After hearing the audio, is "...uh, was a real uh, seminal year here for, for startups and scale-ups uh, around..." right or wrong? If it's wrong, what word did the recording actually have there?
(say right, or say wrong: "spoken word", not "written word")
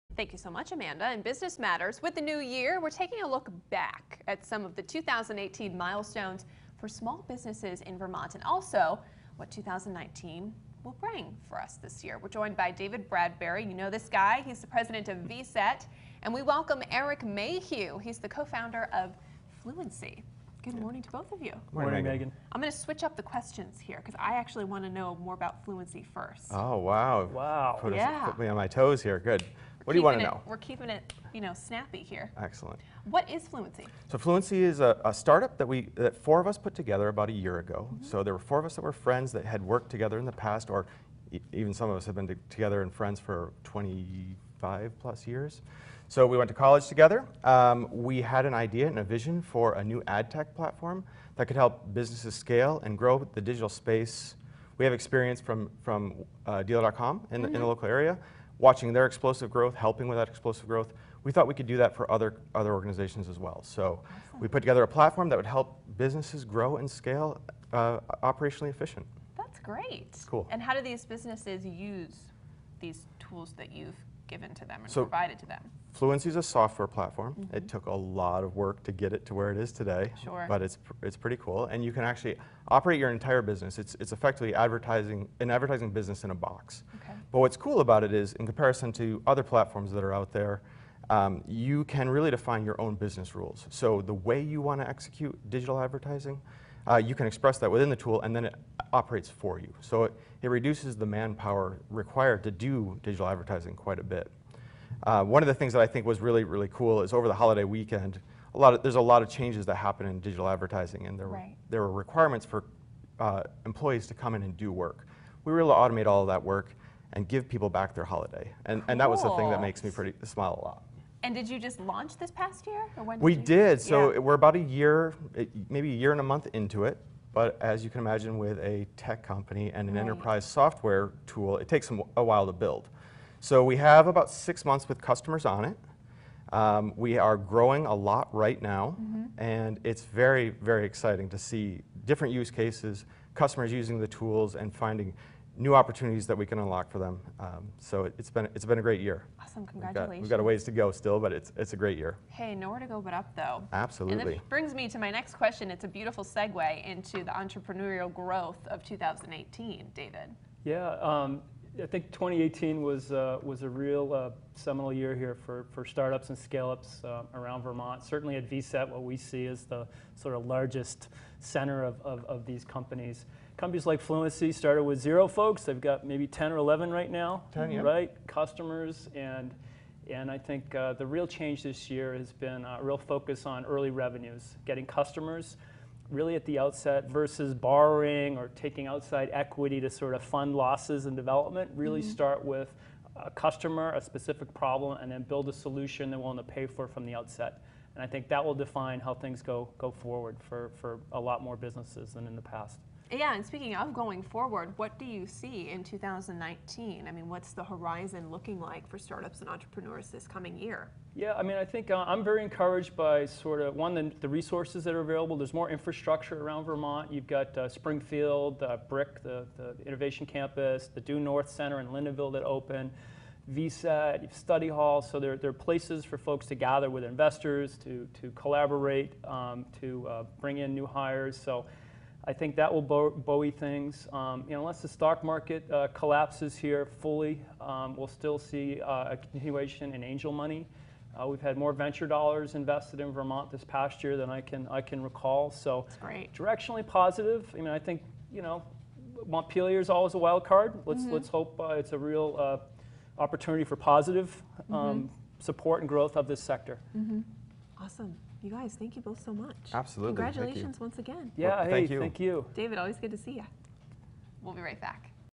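right.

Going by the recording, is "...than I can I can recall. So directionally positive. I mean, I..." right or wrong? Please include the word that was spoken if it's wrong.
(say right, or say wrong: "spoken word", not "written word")
right.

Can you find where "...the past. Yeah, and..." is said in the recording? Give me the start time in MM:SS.
03:22.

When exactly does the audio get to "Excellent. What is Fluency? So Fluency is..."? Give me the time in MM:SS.
00:32.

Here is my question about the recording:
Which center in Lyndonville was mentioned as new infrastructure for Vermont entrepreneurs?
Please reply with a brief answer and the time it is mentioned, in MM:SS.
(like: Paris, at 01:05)
Due North Center, at 03:41.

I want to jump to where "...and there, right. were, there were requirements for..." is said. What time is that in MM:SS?
01:51.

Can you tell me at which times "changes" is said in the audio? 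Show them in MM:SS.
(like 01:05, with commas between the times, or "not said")
01:49, 03:01.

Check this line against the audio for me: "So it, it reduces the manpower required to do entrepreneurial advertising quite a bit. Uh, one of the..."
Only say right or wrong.
wrong.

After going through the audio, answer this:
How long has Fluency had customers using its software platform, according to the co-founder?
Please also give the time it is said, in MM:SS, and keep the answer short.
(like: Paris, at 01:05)
6 months, at 02:14.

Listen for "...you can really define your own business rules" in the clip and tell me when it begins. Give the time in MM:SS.
01:31.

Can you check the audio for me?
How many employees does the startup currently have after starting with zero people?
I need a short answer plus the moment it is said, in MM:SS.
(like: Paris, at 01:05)
10, at 02:57.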